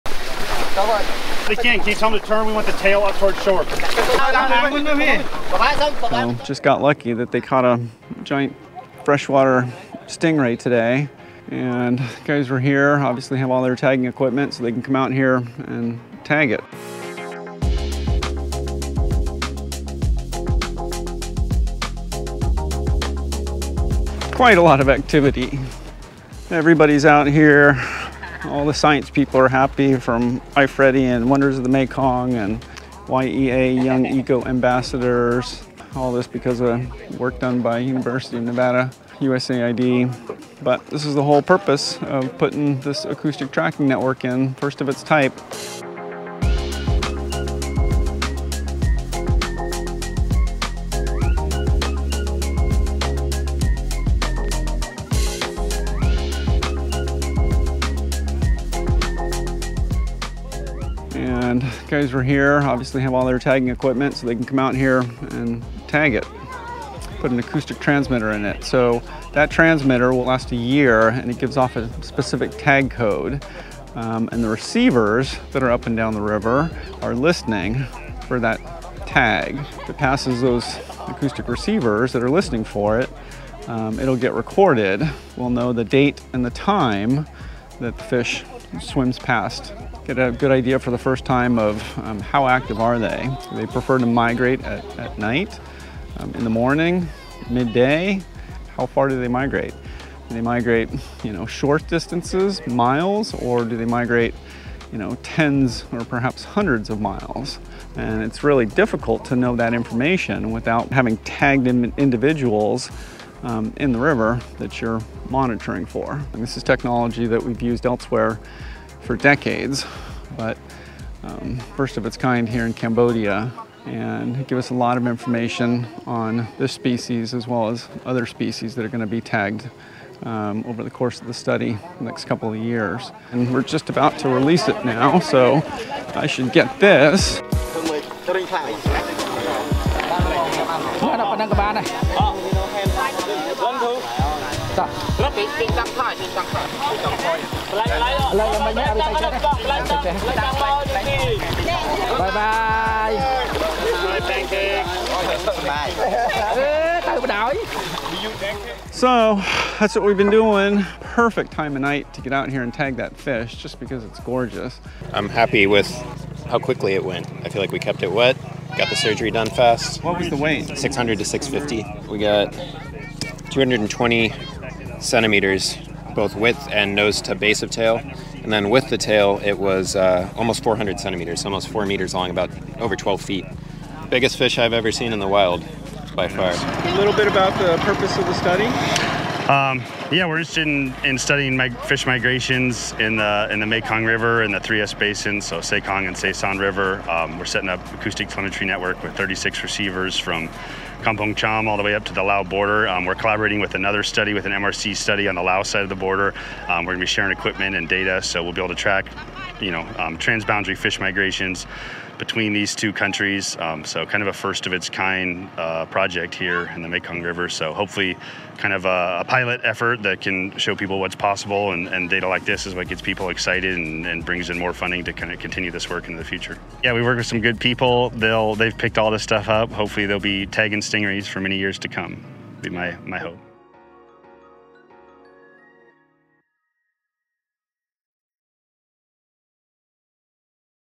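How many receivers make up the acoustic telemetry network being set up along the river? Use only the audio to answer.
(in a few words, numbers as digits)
36.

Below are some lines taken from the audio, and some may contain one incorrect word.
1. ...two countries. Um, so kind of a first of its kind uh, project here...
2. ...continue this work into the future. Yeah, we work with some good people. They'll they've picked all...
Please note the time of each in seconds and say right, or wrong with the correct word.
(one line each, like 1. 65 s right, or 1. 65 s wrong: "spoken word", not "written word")
1. 212 s right
2. 225 s right.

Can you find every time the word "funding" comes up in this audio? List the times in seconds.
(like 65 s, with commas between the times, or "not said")
224 s.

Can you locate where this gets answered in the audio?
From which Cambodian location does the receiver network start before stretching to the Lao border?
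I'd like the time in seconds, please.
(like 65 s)
201 s.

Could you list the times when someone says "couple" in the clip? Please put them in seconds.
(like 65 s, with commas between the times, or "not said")
132 s.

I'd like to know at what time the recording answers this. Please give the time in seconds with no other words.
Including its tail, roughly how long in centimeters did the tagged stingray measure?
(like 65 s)
180 s.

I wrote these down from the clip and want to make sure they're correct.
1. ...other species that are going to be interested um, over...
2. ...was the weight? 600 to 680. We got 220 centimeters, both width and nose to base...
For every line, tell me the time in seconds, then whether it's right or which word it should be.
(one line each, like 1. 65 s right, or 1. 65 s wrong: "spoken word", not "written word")
1. 128 s wrong: "tagged", not "interested"
2. 170 s wrong: "650", not "680".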